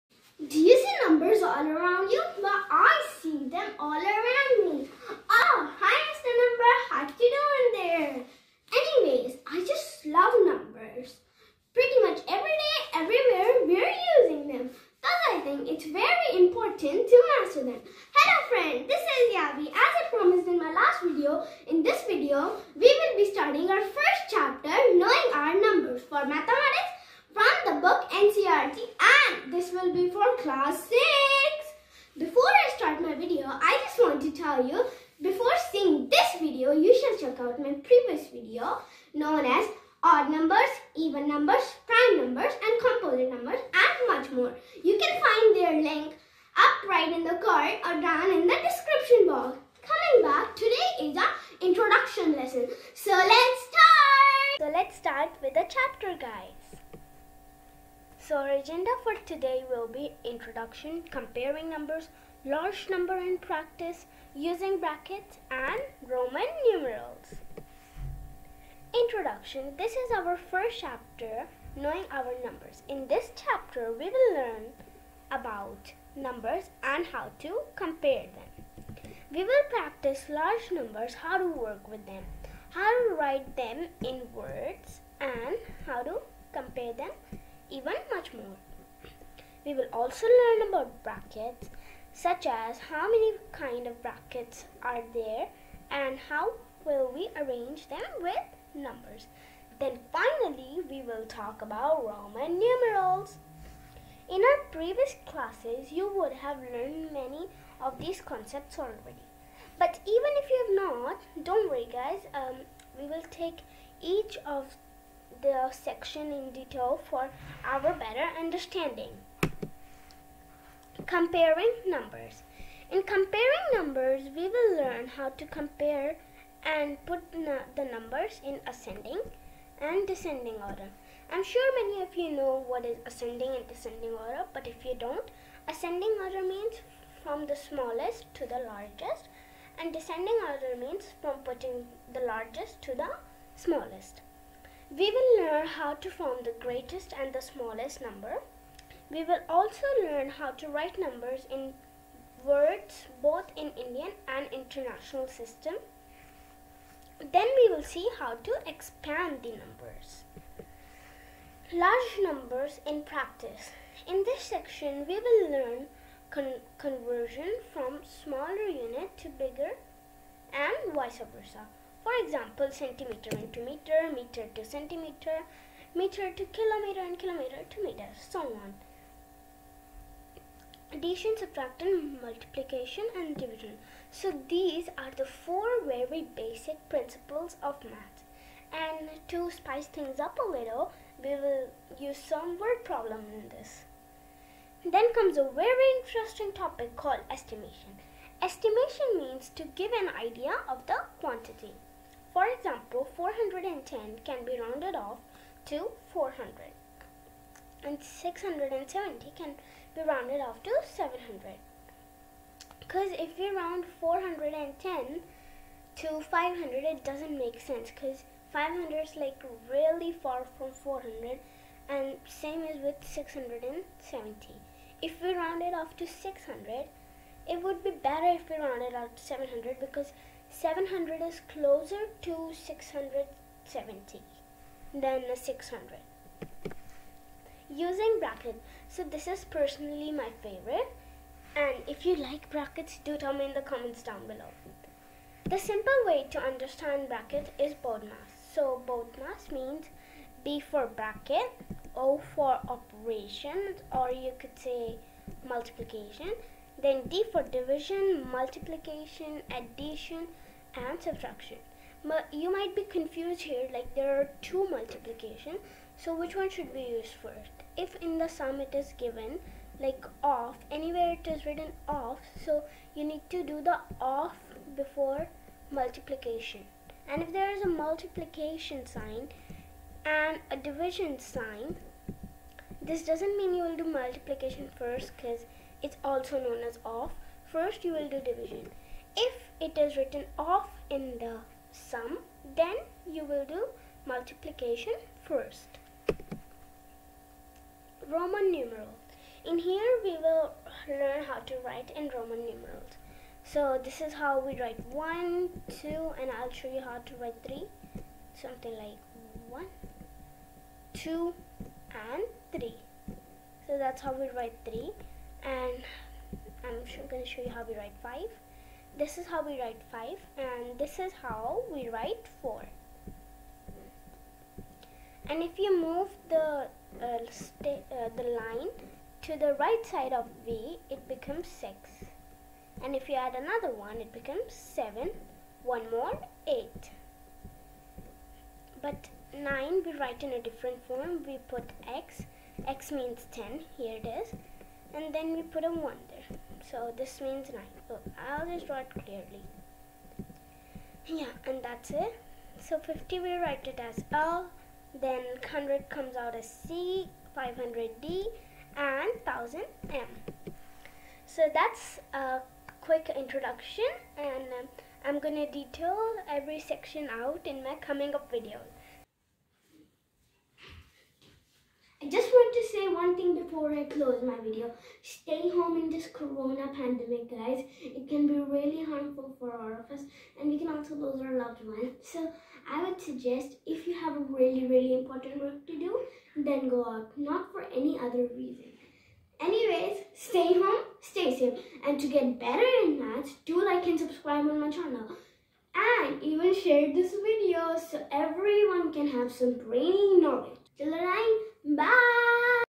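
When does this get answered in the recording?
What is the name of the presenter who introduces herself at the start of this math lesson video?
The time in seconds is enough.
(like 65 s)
19 s.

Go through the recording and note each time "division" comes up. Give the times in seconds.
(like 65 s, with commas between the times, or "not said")
183 s, 257 s, 280 s, 288 s.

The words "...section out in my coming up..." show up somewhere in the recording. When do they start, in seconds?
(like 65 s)
366 s.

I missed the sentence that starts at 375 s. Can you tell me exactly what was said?
Stay home in this corona pandemic, guys.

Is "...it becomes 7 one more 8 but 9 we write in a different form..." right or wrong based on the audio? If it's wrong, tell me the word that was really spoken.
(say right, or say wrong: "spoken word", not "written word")
right.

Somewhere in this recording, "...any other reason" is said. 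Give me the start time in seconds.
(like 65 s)
387 s.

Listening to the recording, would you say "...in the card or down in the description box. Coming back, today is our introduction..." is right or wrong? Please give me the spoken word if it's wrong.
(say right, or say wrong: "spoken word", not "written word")
right.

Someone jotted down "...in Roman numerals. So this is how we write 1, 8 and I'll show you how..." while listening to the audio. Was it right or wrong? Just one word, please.
wrong.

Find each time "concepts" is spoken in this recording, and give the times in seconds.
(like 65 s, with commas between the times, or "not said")
108 s.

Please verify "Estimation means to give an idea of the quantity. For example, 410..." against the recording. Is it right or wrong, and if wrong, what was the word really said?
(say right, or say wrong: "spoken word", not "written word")
right.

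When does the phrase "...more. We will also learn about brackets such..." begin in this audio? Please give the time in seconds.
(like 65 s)
88 s.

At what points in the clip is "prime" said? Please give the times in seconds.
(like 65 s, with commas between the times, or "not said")
41 s.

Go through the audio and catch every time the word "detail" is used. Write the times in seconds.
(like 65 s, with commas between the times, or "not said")
116 s, 365 s.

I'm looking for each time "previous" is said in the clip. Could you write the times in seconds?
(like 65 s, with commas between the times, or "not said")
37 s, 104 s.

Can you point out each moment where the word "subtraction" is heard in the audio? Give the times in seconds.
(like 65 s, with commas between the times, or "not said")
181 s, 261 s.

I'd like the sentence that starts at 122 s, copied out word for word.
In comparing numbers, we will learn how to compare and put the numbers in ascending and descending order.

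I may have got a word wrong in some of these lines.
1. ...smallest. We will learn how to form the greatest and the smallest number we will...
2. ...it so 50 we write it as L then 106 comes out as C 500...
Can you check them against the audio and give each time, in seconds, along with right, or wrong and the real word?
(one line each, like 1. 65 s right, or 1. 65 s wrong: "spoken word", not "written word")
1. 143 s right
2. 351 s wrong: "100", not "106".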